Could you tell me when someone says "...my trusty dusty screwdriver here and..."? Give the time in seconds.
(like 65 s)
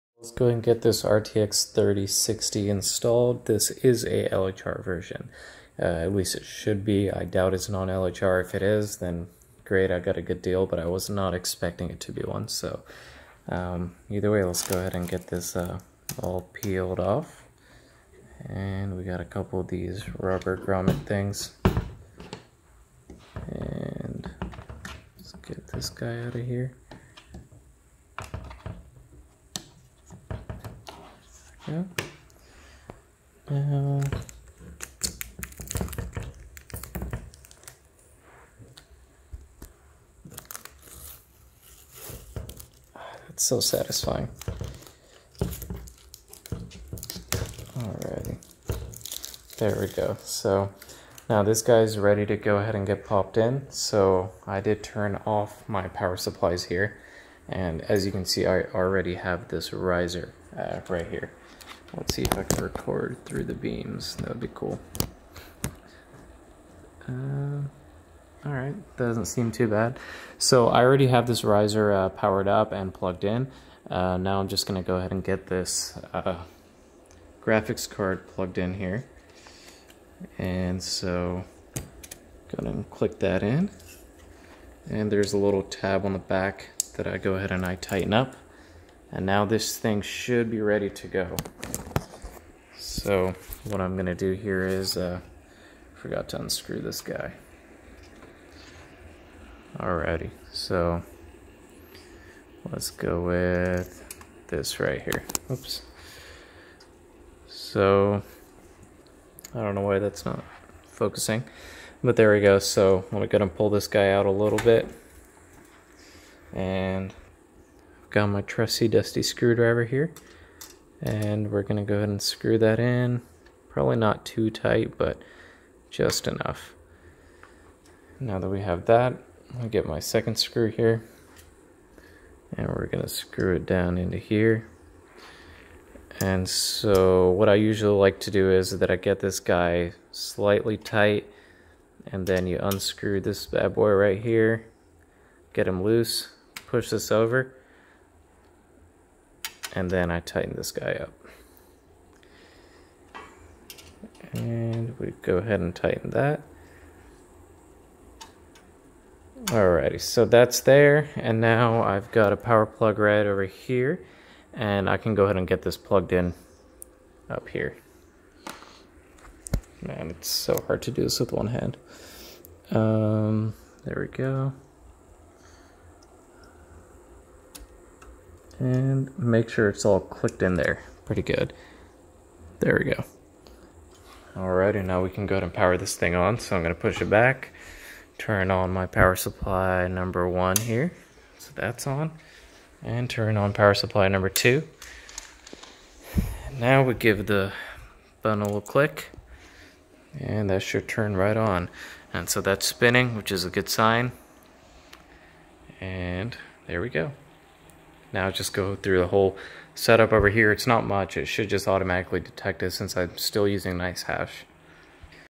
118 s.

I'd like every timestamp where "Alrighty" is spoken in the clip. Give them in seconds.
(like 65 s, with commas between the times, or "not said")
47 s, 99 s, 159 s, 184 s.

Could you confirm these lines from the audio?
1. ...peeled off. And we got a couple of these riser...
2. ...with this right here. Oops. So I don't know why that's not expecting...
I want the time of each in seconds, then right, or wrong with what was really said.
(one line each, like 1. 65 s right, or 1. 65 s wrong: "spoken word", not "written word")
1. 16 s wrong: "rubber", not "riser"
2. 103 s wrong: "focusing", not "expecting".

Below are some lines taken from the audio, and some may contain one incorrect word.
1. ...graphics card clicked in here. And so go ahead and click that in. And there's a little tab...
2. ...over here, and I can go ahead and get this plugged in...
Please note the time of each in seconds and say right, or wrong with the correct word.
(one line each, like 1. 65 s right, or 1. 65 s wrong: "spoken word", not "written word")
1. 77 s wrong: "plugged", not "clicked"
2. 163 s right.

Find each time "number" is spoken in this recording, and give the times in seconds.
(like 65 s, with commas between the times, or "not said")
189 s, 194 s.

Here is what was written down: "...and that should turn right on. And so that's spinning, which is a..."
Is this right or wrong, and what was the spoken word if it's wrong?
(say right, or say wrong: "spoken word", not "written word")
right.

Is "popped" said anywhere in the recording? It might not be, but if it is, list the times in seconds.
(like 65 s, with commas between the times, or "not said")
53 s.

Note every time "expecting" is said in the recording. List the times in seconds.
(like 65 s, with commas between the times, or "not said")
11 s.